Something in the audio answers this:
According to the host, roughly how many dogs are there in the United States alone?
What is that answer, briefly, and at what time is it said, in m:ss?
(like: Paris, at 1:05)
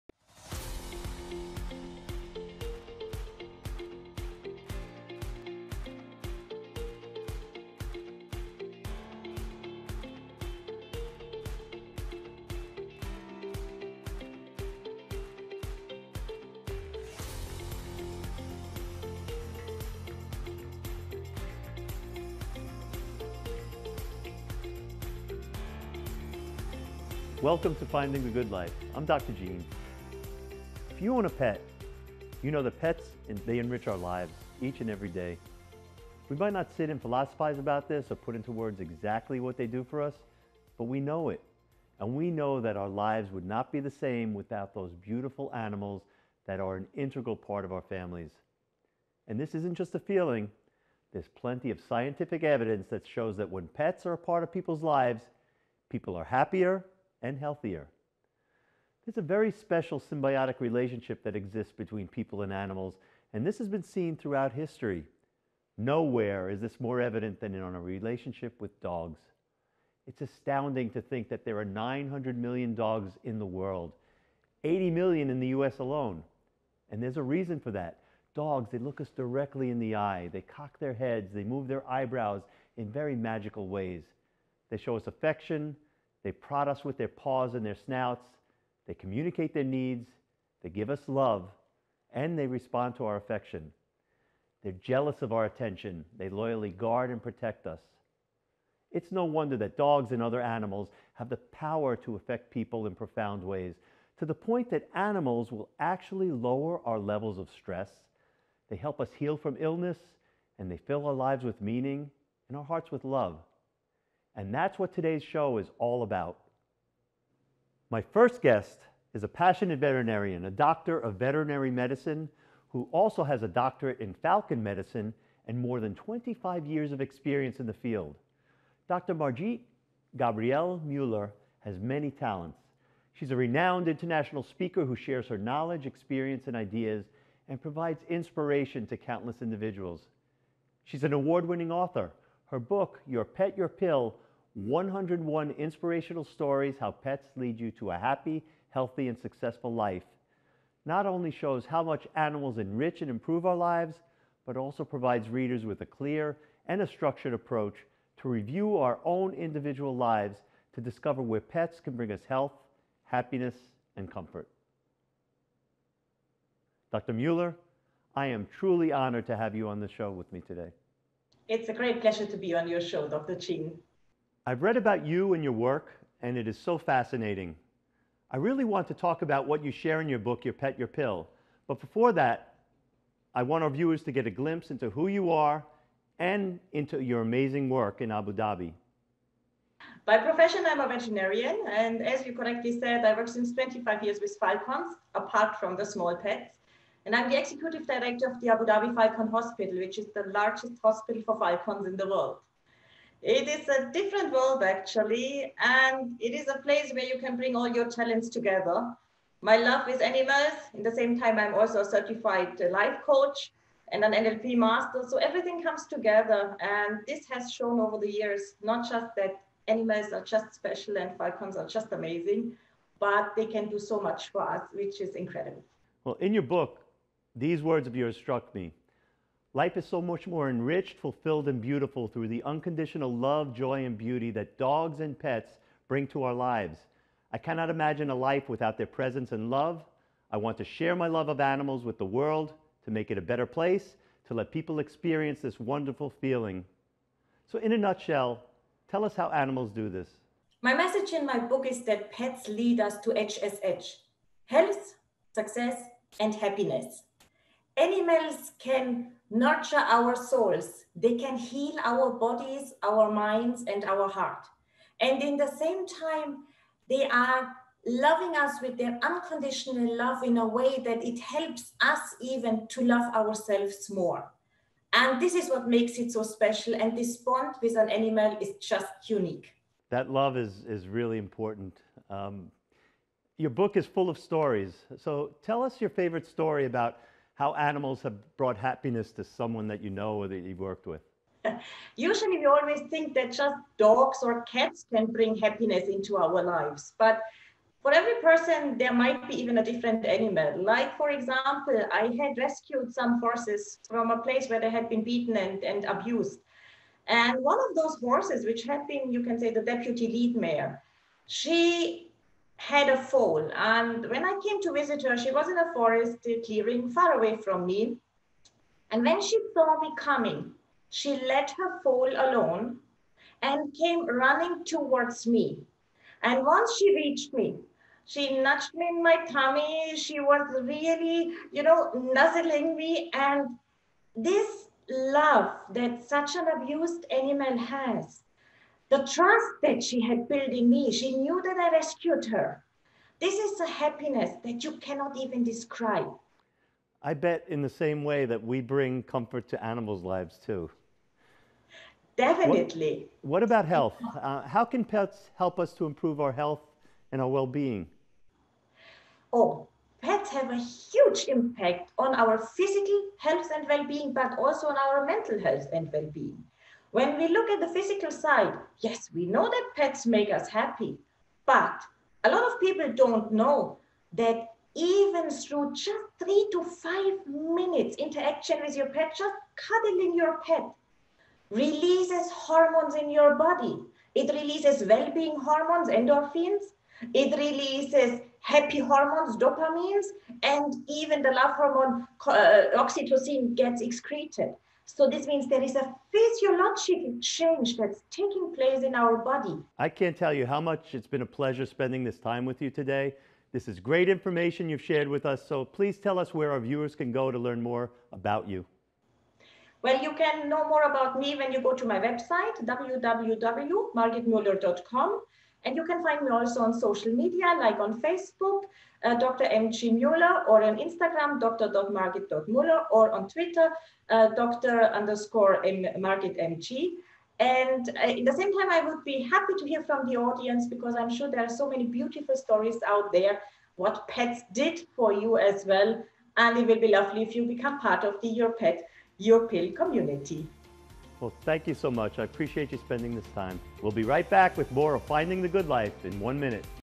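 80 million, at 1:14.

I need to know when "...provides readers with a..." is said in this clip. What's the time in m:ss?
2:34.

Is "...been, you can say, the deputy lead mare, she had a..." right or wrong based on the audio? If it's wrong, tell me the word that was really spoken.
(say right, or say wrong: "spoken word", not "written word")
right.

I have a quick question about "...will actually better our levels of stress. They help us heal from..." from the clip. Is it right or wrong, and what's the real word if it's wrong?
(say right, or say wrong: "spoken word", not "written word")
wrong: "lower", not "better".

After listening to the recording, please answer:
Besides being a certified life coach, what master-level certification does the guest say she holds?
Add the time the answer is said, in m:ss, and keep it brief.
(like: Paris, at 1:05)
NLP master, at 3:34.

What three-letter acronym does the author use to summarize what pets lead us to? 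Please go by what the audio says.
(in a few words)
HSH.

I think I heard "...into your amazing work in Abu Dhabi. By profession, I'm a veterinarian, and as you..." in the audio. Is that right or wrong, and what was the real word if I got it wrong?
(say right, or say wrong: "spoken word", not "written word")
right.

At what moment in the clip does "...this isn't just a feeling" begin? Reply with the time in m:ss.
0:49.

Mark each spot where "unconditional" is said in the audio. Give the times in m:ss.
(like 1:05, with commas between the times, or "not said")
3:52, 4:29.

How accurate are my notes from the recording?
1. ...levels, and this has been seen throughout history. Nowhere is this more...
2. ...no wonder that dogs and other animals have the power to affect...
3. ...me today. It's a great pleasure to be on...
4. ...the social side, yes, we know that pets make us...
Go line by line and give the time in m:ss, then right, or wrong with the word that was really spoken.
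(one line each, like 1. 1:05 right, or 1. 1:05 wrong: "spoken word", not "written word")
1. 1:02 wrong: "animals", not "levels"
2. 1:39 right
3. 2:50 right
4. 6:07 wrong: "physical", not "social".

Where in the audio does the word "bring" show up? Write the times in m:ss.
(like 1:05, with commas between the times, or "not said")
2:41, 3:27, 3:55, 4:55, 5:48.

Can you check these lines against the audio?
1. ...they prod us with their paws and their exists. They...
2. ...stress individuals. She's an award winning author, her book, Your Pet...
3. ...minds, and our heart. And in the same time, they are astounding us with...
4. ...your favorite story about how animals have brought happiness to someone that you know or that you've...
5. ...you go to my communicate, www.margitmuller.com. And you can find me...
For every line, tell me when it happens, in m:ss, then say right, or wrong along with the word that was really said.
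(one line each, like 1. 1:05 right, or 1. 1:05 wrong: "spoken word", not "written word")
1. 1:26 wrong: "snouts", not "exists"
2. 2:18 wrong: "countless", not "stress"
3. 4:23 wrong: "loving", not "astounding"
4. 4:45 right
5. 6:51 wrong: "website", not "communicate".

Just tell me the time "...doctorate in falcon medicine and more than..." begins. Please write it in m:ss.
2:03.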